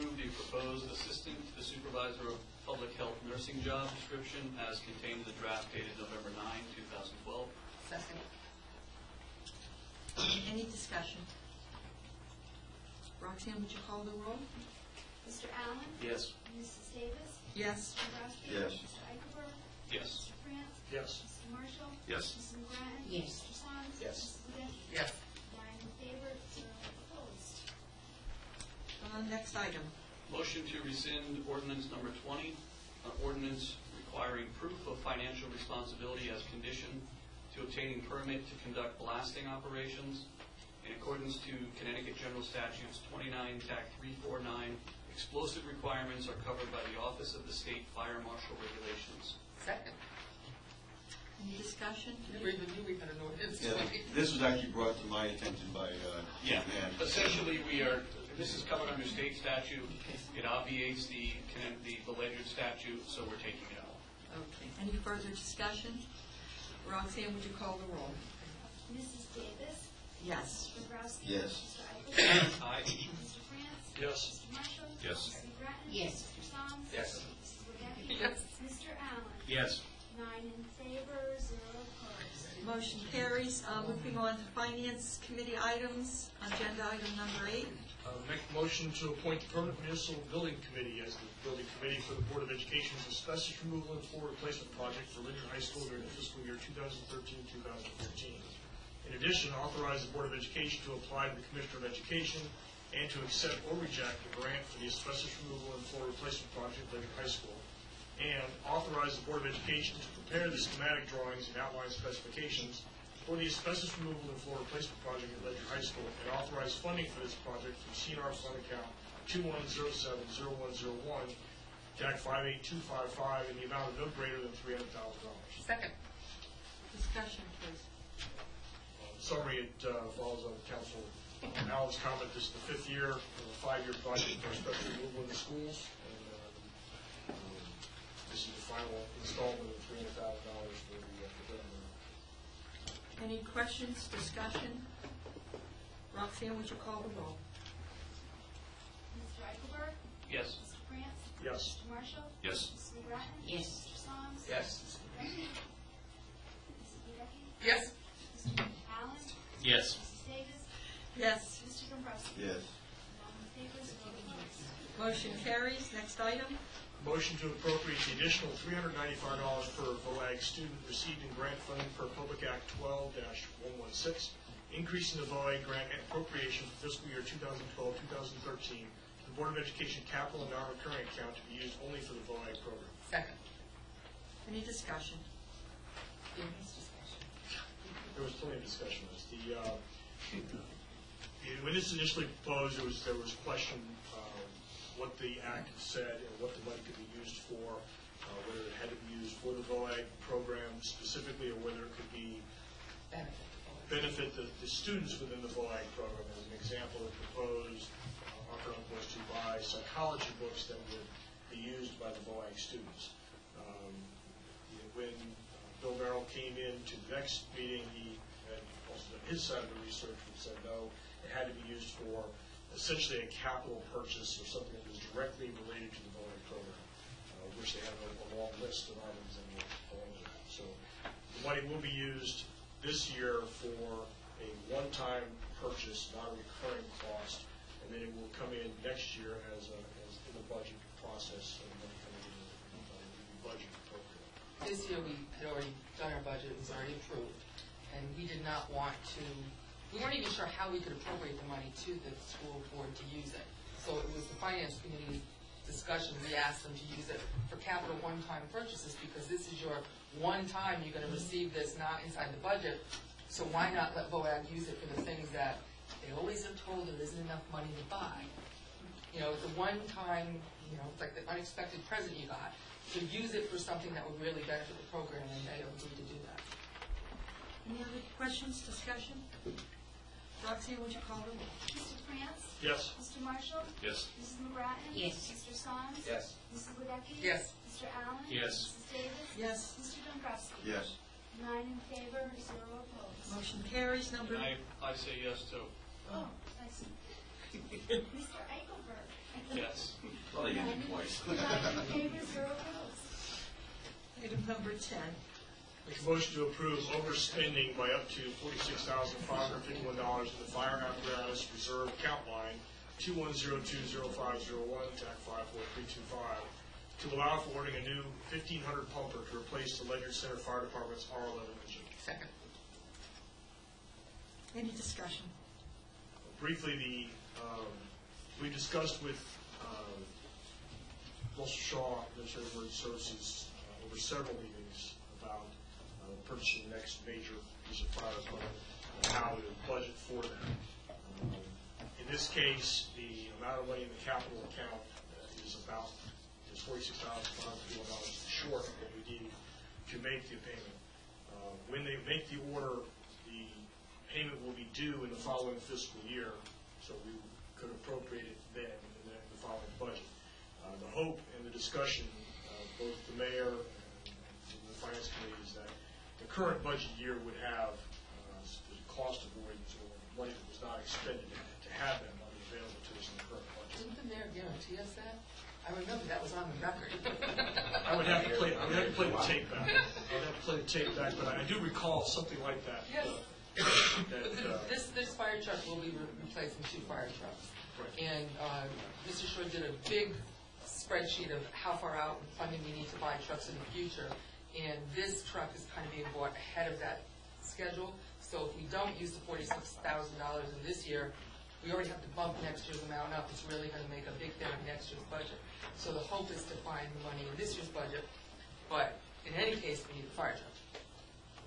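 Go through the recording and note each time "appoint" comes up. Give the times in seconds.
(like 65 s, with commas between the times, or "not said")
89 s.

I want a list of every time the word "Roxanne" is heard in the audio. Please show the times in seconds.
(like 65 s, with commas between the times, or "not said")
13 s, 66 s, 146 s.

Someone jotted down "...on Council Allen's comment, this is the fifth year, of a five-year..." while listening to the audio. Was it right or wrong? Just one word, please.
right.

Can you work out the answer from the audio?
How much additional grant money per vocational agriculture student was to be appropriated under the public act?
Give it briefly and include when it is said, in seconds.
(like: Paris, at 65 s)
$395, at 168 s.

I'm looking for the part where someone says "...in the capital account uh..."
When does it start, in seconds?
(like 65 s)
343 s.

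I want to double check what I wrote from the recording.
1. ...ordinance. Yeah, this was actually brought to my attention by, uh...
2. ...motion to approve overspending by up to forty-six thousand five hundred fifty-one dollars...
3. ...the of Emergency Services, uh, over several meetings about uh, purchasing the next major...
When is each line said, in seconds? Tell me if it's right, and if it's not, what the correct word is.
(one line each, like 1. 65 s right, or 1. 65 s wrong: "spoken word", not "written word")
1. 53 s right
2. 306 s right
3. 332 s right.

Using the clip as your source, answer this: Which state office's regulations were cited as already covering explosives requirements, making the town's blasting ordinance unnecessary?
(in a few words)
Office of the State Fire Marshal.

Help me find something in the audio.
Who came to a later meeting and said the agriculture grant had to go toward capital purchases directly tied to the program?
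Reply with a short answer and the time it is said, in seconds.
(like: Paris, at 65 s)
Bill Merrill, at 215 s.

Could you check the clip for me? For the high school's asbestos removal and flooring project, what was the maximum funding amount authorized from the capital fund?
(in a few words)
$300,000.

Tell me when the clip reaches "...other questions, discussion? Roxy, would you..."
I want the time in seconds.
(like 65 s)
277 s.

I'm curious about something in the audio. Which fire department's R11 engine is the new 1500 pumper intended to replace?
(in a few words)
Ledyard Center Fire Department.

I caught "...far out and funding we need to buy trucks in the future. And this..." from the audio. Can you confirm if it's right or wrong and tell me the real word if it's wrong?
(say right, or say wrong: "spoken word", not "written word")
right.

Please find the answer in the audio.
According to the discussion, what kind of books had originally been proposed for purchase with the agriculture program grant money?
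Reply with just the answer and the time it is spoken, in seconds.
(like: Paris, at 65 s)
Psychology books, at 209 s.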